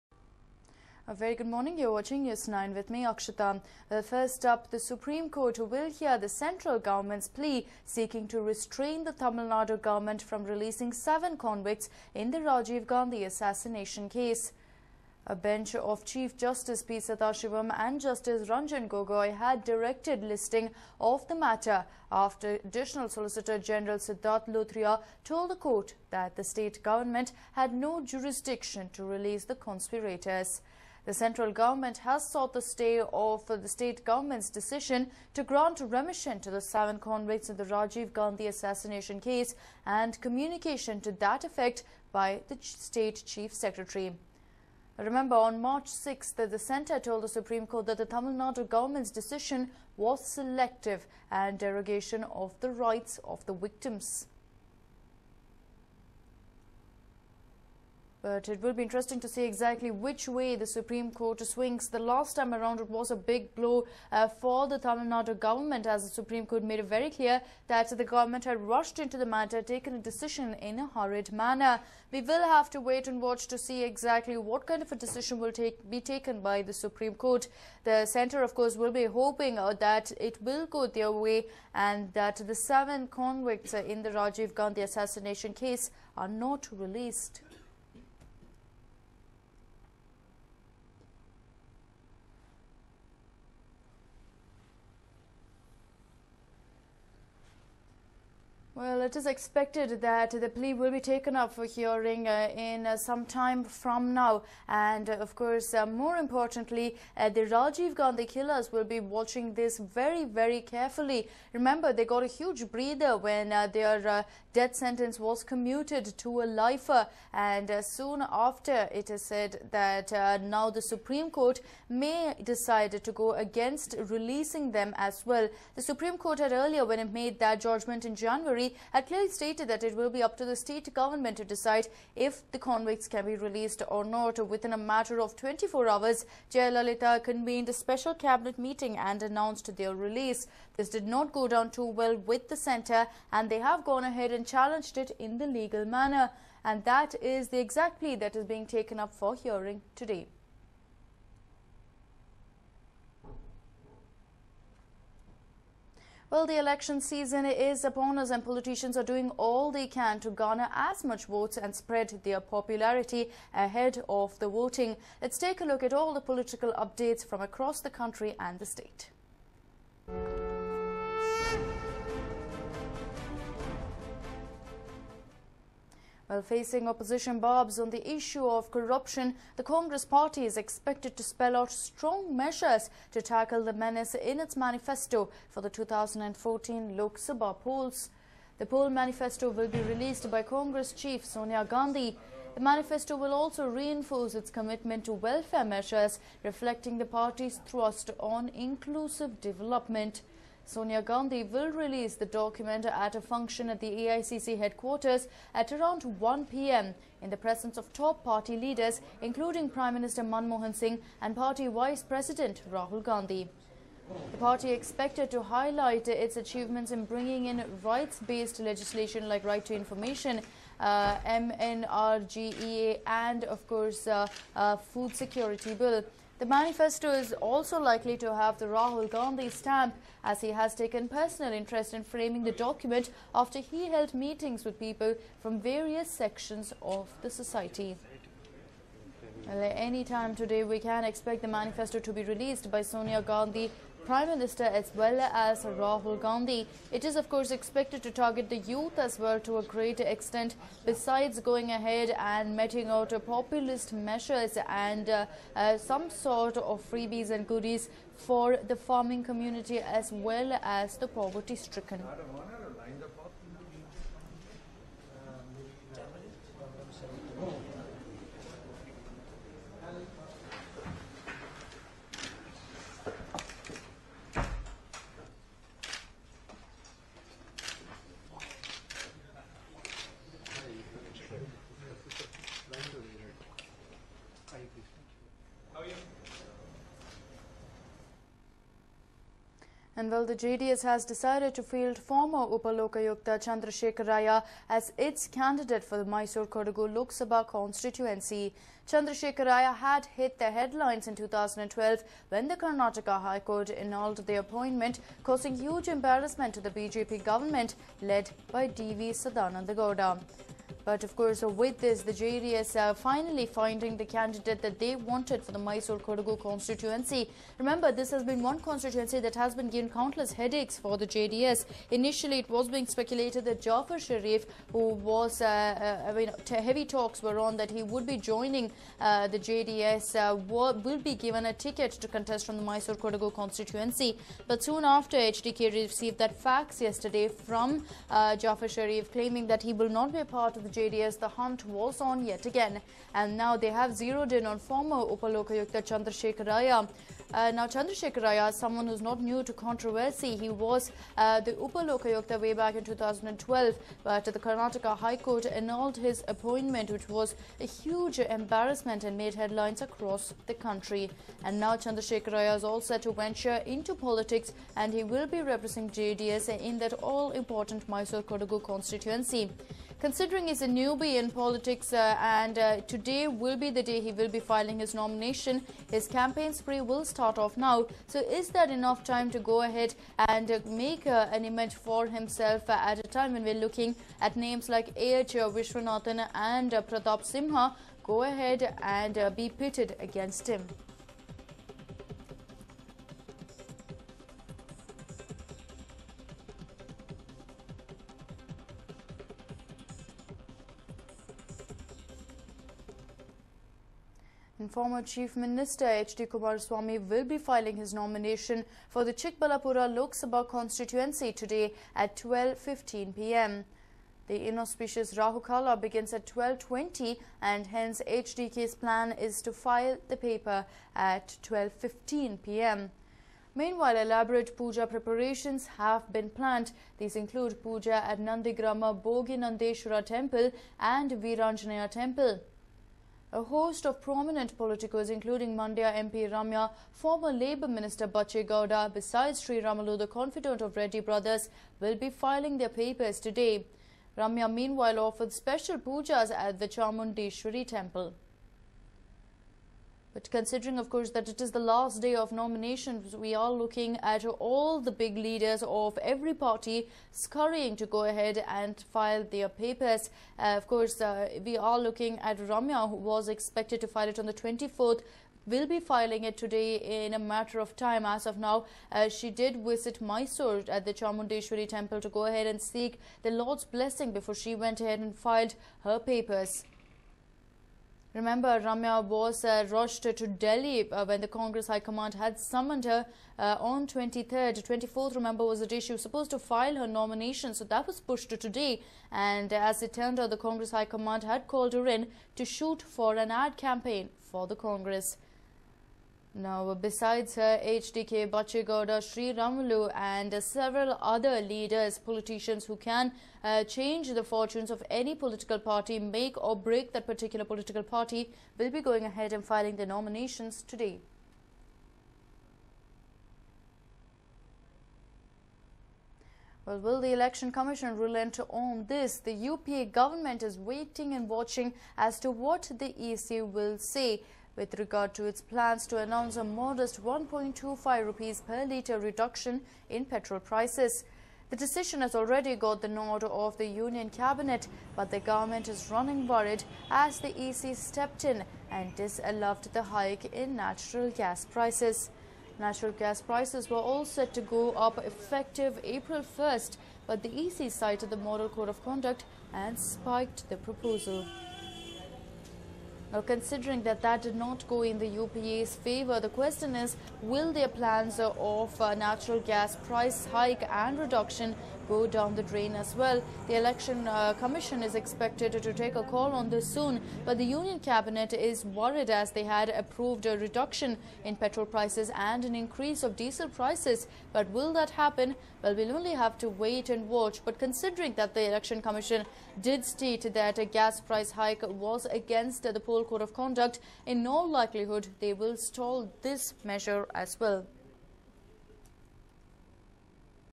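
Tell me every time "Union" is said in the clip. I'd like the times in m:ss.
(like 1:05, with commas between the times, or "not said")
8:53, 9:27.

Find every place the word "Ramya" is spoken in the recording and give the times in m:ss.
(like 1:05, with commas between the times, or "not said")
7:16, 7:24, 7:42, 7:58.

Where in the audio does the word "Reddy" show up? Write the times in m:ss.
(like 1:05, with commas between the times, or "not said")
7:20.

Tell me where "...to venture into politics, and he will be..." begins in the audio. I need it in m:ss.
6:03.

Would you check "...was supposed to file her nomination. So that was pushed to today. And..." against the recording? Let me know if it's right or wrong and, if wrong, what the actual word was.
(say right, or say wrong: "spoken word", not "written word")
right.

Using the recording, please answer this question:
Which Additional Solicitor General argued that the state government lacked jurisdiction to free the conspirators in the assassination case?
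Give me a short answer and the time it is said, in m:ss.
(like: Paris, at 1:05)
Siddharth Luthra, at 0:23.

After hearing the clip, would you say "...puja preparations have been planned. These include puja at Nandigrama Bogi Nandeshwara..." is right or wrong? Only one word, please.
right.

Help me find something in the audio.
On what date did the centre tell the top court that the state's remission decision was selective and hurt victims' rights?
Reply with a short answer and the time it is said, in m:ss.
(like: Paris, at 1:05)
March 6th, at 0:45.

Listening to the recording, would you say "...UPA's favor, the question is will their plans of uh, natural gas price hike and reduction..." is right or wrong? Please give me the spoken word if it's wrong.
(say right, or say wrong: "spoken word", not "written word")
right.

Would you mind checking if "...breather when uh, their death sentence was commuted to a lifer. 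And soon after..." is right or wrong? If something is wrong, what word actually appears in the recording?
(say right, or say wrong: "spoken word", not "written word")
right.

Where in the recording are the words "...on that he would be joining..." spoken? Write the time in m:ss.
5:27.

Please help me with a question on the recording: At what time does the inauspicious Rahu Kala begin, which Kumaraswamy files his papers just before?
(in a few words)
12.20.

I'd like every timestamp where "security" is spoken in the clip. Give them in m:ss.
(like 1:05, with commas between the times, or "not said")
3:45.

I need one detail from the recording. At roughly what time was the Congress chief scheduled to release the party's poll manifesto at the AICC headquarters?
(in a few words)
1 p.m.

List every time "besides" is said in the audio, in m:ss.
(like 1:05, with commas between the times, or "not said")
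4:10, 7:18, 8:16.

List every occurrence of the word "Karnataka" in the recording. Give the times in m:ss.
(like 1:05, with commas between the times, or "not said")
5:02, 5:54.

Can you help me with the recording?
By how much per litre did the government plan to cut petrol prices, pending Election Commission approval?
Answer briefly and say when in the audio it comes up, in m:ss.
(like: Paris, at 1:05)
1.25 rupees, at 8:47.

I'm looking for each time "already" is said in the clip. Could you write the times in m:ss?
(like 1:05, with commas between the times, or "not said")
8:52.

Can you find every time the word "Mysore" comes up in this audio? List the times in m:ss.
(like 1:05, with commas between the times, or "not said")
4:56, 5:15, 5:32, 6:07, 7:50.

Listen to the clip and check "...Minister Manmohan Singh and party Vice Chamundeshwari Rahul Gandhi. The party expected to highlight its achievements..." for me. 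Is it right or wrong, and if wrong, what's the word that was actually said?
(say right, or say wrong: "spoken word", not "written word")
wrong: "President", not "Chamundeshwari".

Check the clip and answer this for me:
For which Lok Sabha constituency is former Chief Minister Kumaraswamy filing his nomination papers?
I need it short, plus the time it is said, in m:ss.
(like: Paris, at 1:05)
Chikbalapura, at 6:49.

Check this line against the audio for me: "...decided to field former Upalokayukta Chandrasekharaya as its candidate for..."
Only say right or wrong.
right.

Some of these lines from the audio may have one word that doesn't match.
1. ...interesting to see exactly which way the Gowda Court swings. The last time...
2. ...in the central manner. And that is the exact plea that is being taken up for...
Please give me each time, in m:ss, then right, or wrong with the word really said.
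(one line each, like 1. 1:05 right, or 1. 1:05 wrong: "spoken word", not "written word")
1. 0:58 wrong: "Supreme", not "Gowda"
2. 2:25 wrong: "legal", not "central".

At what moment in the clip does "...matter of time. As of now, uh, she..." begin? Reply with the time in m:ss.
7:47.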